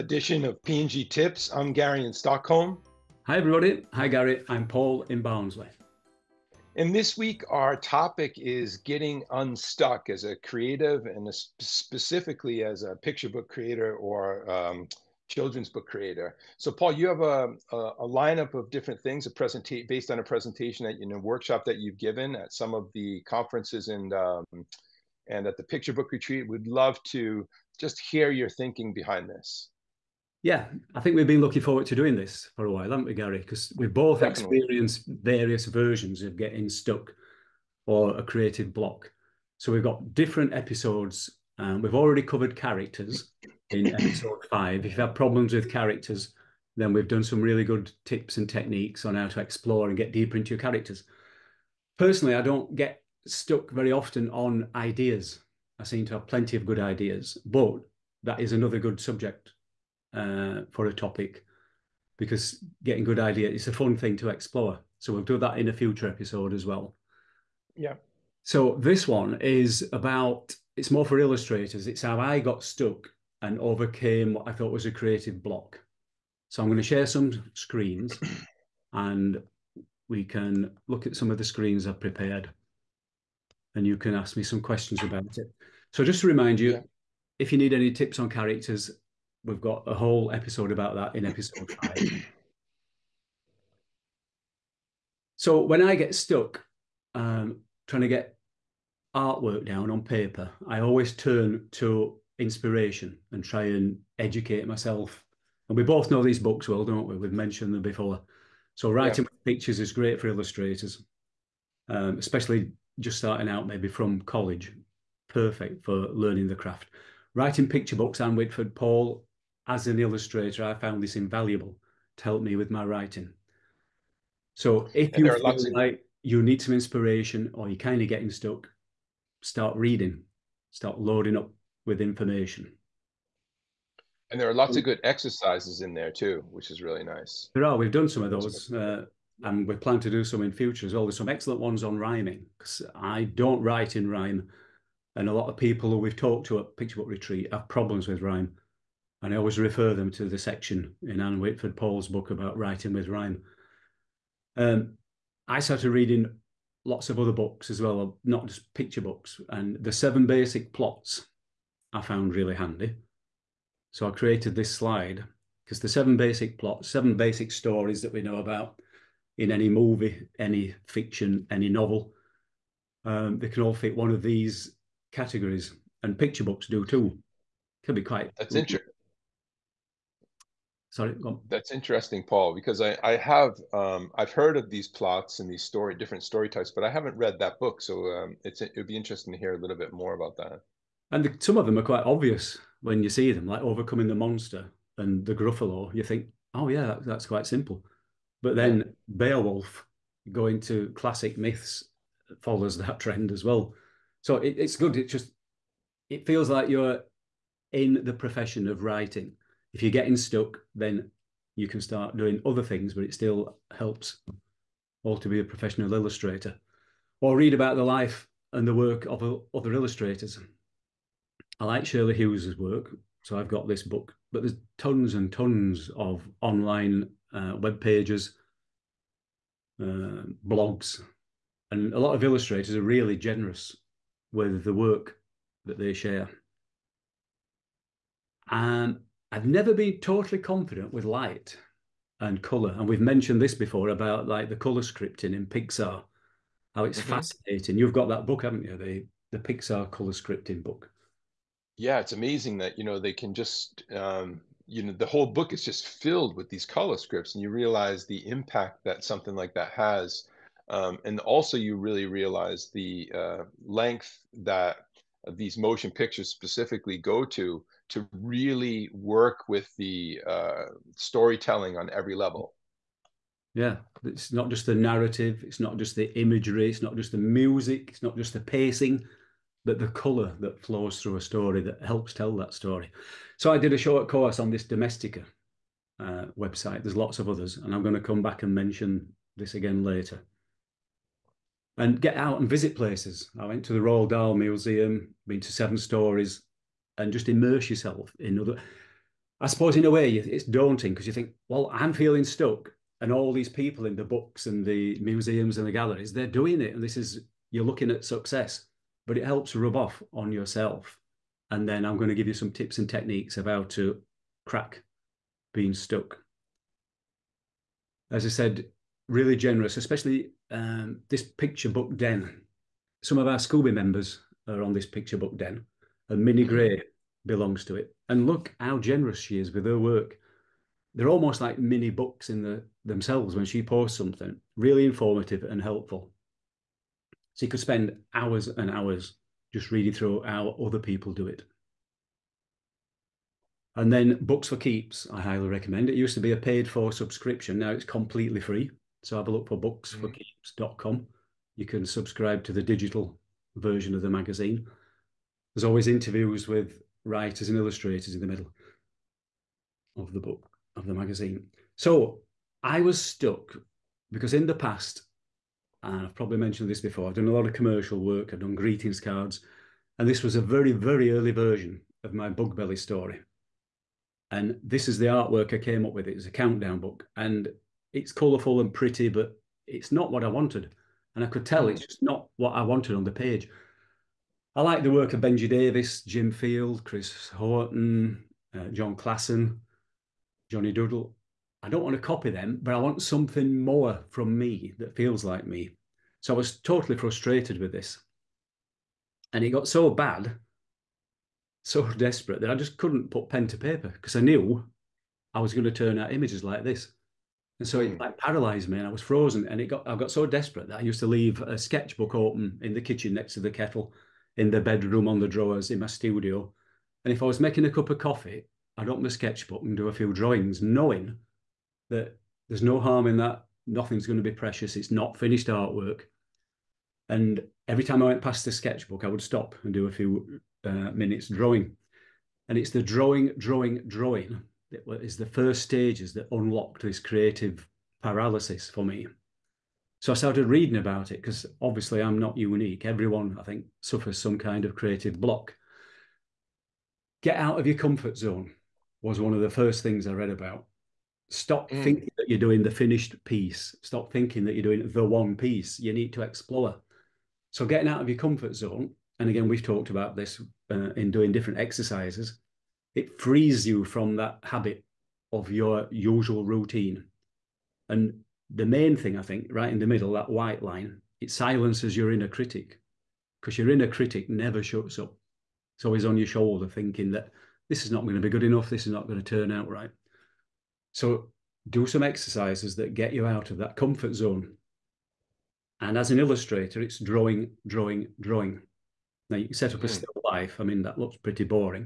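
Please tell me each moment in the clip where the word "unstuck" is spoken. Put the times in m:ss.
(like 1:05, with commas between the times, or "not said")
0:09.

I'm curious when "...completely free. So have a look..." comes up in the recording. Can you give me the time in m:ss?
5:47.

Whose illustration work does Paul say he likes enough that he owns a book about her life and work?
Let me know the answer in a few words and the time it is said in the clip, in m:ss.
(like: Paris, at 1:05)
Shirley Hughes, at 3:41.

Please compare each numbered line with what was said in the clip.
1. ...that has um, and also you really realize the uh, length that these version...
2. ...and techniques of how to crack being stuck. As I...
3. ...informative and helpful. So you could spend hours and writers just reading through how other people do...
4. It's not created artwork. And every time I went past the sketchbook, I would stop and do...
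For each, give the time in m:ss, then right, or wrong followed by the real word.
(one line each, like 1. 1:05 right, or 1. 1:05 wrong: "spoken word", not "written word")
1. 4:19 wrong: "motion", not "version"
2. 5:12 right
3. 5:34 wrong: "hours", not "writers"
4. 7:04 wrong: "finished", not "created".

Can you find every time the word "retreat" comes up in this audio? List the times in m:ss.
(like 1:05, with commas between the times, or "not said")
0:26, 2:27.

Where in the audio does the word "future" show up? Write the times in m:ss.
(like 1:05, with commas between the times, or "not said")
1:05, 2:20.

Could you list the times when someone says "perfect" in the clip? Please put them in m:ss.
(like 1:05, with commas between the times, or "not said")
1:55.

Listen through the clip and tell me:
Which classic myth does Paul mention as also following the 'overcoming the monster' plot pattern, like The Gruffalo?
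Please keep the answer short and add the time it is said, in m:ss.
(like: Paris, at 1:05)
Beowulf, at 3:19.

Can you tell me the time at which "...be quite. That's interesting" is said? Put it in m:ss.
2:57.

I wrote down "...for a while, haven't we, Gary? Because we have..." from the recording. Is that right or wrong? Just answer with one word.
right.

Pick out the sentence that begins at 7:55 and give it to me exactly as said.
It's always on your shoulder thinking that this is not going to be good enough.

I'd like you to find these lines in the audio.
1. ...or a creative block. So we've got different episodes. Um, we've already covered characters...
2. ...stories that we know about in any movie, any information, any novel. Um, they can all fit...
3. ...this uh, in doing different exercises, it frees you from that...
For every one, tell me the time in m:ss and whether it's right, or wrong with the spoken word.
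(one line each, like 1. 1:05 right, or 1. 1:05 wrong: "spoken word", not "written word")
1. 0:37 right
2. 2:47 wrong: "fiction", not "information"
3. 7:40 right.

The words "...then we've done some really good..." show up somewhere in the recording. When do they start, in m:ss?
0:46.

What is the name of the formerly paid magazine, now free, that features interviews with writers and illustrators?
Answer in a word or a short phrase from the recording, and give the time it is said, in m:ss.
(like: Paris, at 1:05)
Books for Keeps, at 5:44.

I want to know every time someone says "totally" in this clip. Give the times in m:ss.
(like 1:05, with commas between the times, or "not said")
3:59, 6:36.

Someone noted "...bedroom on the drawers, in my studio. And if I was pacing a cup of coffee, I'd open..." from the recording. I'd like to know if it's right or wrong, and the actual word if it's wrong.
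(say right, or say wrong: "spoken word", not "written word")
wrong: "making", not "pacing".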